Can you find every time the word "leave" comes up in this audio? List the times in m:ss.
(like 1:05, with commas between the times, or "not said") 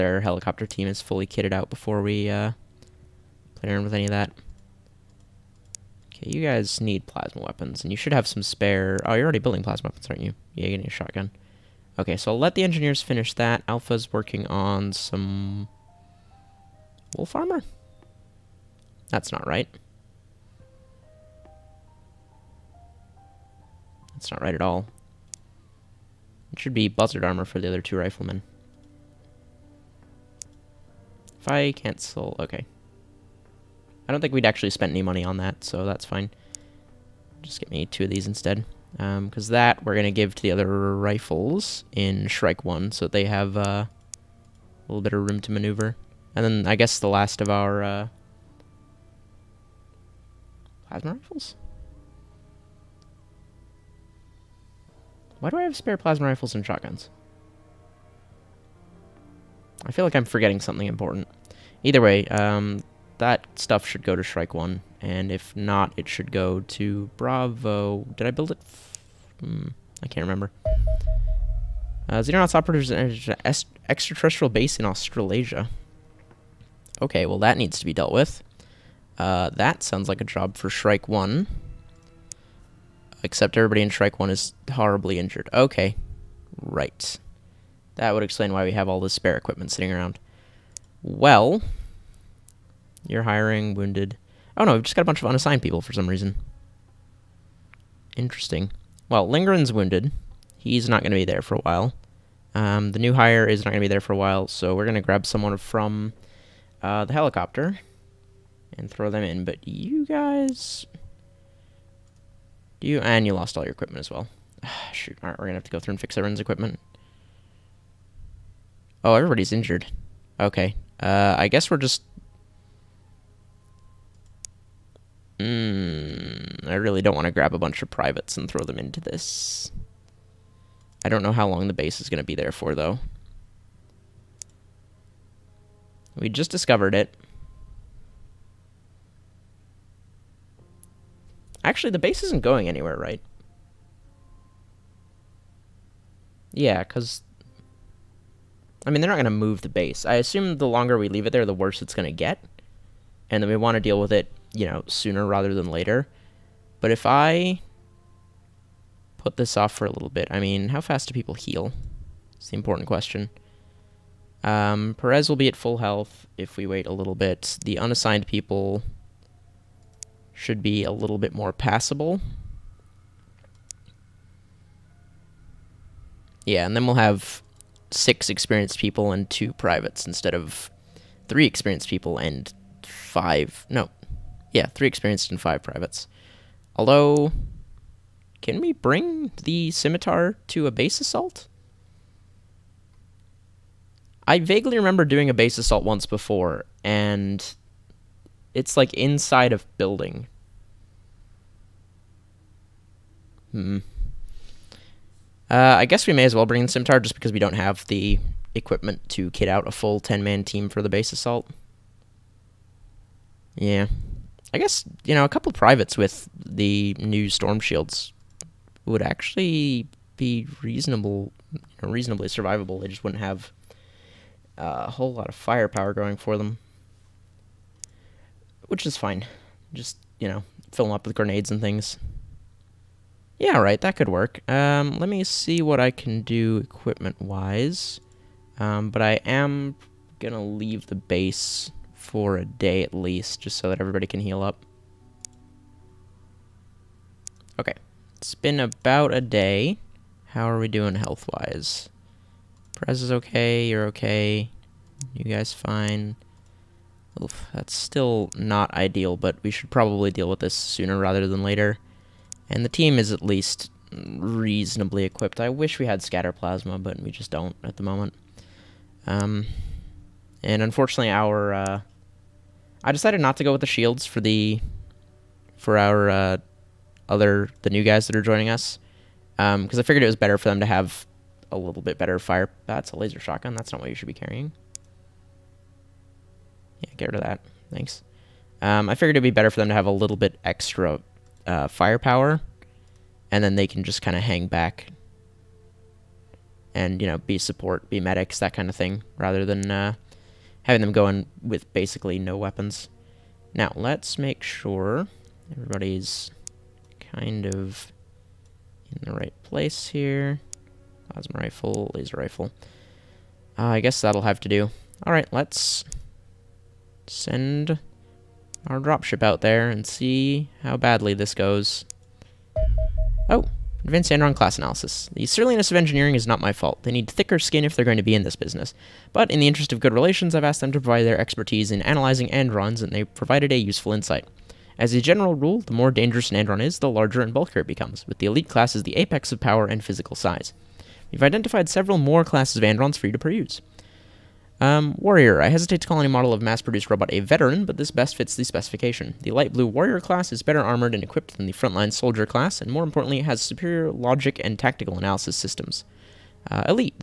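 2:31, 4:00.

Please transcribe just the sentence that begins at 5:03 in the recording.
Now, let's make sure everybody's kind of in the right place here.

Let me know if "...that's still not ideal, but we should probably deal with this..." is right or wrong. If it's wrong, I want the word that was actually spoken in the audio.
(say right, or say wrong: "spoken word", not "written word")
right.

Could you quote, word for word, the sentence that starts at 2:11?
I don't know how long the base is going to be there for, though.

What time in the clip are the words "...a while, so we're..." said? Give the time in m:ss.
1:44.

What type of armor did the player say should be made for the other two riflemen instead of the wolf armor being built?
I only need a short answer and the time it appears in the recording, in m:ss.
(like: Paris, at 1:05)
Buzzard armor, at 0:26.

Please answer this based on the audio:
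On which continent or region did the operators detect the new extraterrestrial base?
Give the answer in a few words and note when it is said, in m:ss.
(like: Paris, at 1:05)
Australasia, at 1:14.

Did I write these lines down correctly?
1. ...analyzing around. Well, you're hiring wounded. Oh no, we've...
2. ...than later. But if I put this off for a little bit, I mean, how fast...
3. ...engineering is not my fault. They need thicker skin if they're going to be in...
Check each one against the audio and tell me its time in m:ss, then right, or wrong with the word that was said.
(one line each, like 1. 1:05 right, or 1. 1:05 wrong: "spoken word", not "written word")
1. 1:29 wrong: "sitting", not "analyzing"
2. 2:35 right
3. 5:25 right.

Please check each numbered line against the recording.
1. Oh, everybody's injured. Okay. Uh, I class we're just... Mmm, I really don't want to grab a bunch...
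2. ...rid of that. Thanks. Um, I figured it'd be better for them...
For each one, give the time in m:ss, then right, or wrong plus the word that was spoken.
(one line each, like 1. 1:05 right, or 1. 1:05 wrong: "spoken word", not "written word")
1. 1:59 wrong: "guess", not "class"
2. 4:47 right.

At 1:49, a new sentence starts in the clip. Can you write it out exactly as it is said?
But you guys, you and you lost all your equipment as well.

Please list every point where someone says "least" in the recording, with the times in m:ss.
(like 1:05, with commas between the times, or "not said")
4:02, 4:23.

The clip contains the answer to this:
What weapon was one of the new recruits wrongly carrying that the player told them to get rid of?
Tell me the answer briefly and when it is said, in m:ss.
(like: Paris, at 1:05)
Laser shotgun, at 4:42.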